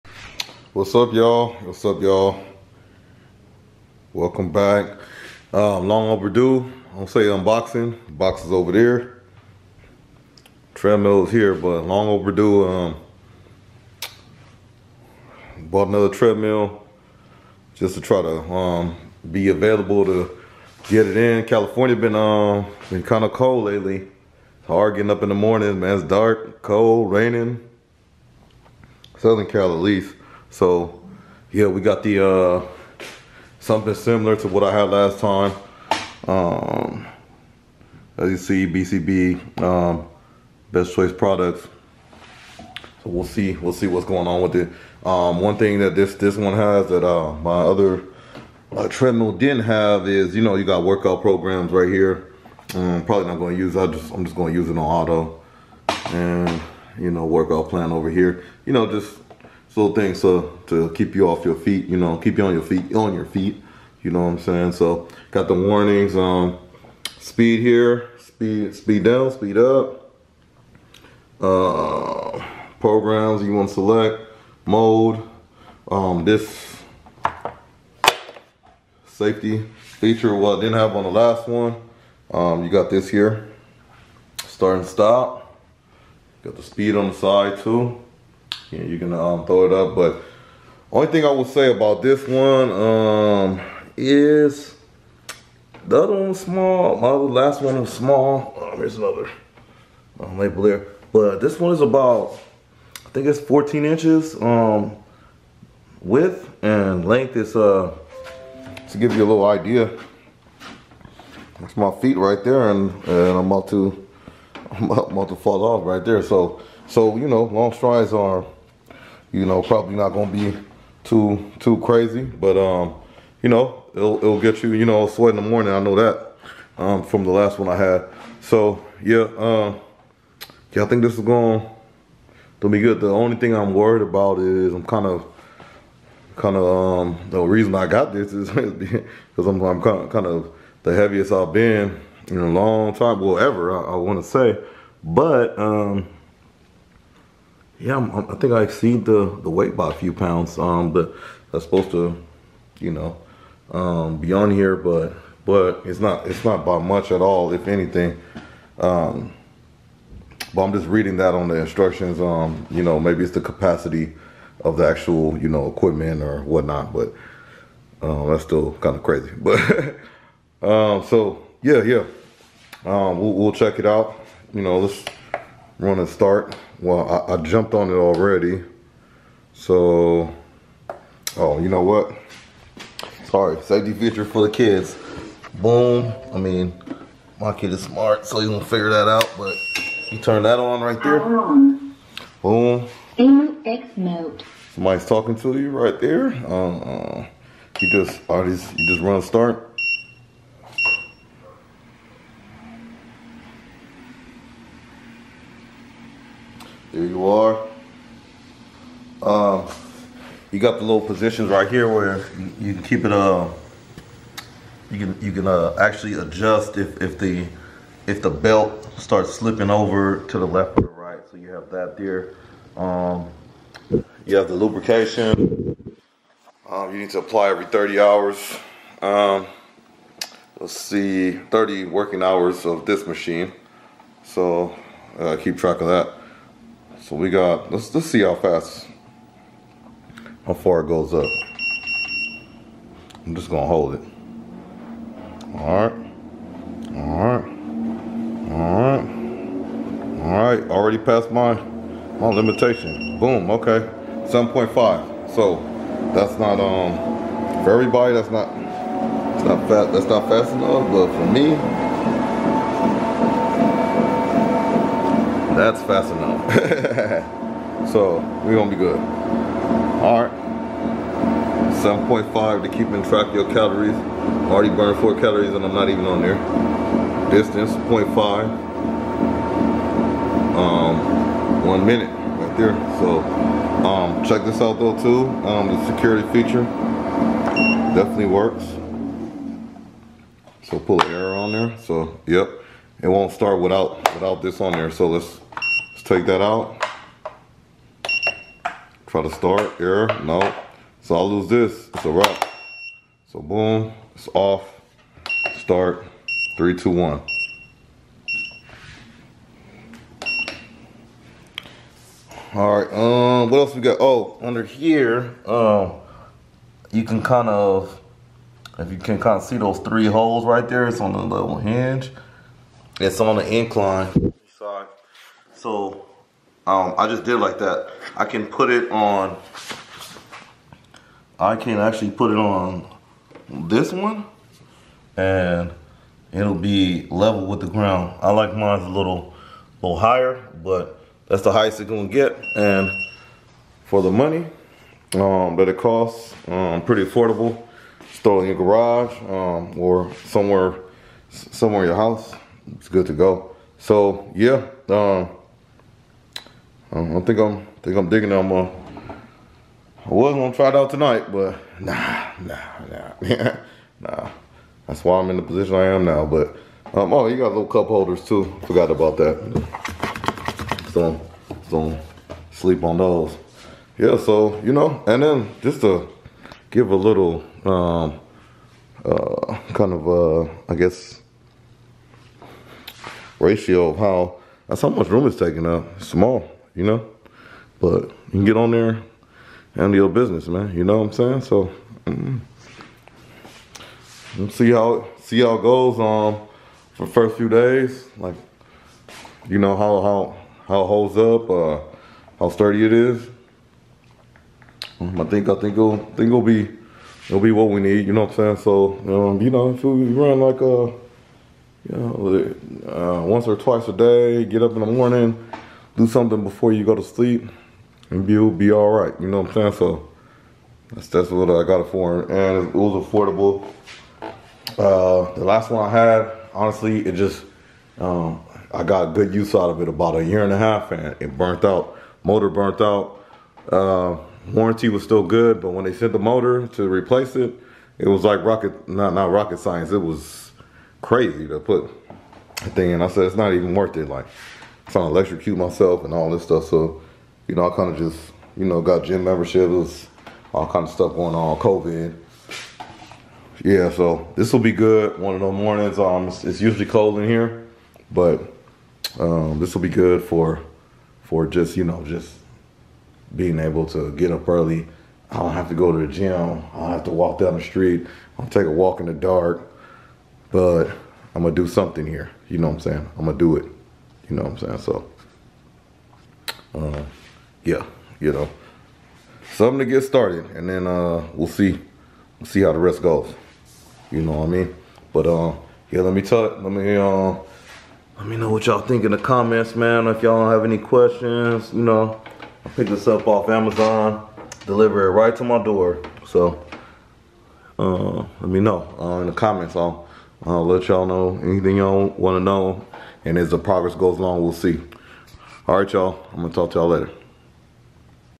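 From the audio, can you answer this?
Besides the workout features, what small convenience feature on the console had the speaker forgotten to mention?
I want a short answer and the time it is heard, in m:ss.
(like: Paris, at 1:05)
cup holders, at 6:07.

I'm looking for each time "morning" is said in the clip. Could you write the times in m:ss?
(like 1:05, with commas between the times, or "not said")
0:25, 2:05, 6:54, 7:35.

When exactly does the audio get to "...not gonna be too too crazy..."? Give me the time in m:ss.
1:59.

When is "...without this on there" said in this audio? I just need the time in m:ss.
4:54.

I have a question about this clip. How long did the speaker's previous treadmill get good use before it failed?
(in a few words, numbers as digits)
a year and a half.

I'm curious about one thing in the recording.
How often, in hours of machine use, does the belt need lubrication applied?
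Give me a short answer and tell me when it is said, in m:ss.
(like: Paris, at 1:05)
30 hours, at 3:51.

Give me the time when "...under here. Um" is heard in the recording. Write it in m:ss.
5:14.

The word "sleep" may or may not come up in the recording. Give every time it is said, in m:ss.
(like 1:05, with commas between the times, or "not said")
6:12, 6:57.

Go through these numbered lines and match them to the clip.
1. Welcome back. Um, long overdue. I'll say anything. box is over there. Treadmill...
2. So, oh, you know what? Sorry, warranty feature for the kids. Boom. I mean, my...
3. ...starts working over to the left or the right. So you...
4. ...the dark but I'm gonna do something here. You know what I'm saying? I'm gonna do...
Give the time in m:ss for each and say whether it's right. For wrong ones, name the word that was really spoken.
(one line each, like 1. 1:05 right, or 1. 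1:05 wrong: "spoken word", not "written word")
1. 0:04 wrong: "unboxing", not "anything"
2. 2:59 wrong: "safety", not "warranty"
3. 3:38 wrong: "slipping", not "working"
4. 7:49 right.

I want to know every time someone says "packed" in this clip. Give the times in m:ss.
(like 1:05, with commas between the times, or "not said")
not said.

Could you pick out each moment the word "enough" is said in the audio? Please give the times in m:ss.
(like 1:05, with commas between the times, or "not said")
4:20, 4:26.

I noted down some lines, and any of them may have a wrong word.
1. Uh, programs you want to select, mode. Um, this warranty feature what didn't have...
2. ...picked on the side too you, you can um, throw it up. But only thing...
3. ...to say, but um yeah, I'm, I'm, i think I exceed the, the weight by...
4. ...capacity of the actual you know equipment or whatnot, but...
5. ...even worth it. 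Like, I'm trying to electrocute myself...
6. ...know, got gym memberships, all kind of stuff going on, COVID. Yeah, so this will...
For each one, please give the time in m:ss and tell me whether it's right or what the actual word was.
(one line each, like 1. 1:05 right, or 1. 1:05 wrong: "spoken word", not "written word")
1. 1:11 wrong: "safety", not "warranty"
2. 1:26 wrong: "speed", not "picked"
3. 2:24 right
4. 2:43 right
5. 7:23 right
6. 7:28 right.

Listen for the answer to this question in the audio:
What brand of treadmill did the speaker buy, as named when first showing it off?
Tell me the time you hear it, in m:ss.
0:40.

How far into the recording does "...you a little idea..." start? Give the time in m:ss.
1:49.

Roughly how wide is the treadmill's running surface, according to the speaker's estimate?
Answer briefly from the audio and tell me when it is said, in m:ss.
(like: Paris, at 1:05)
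14 inches, at 1:43.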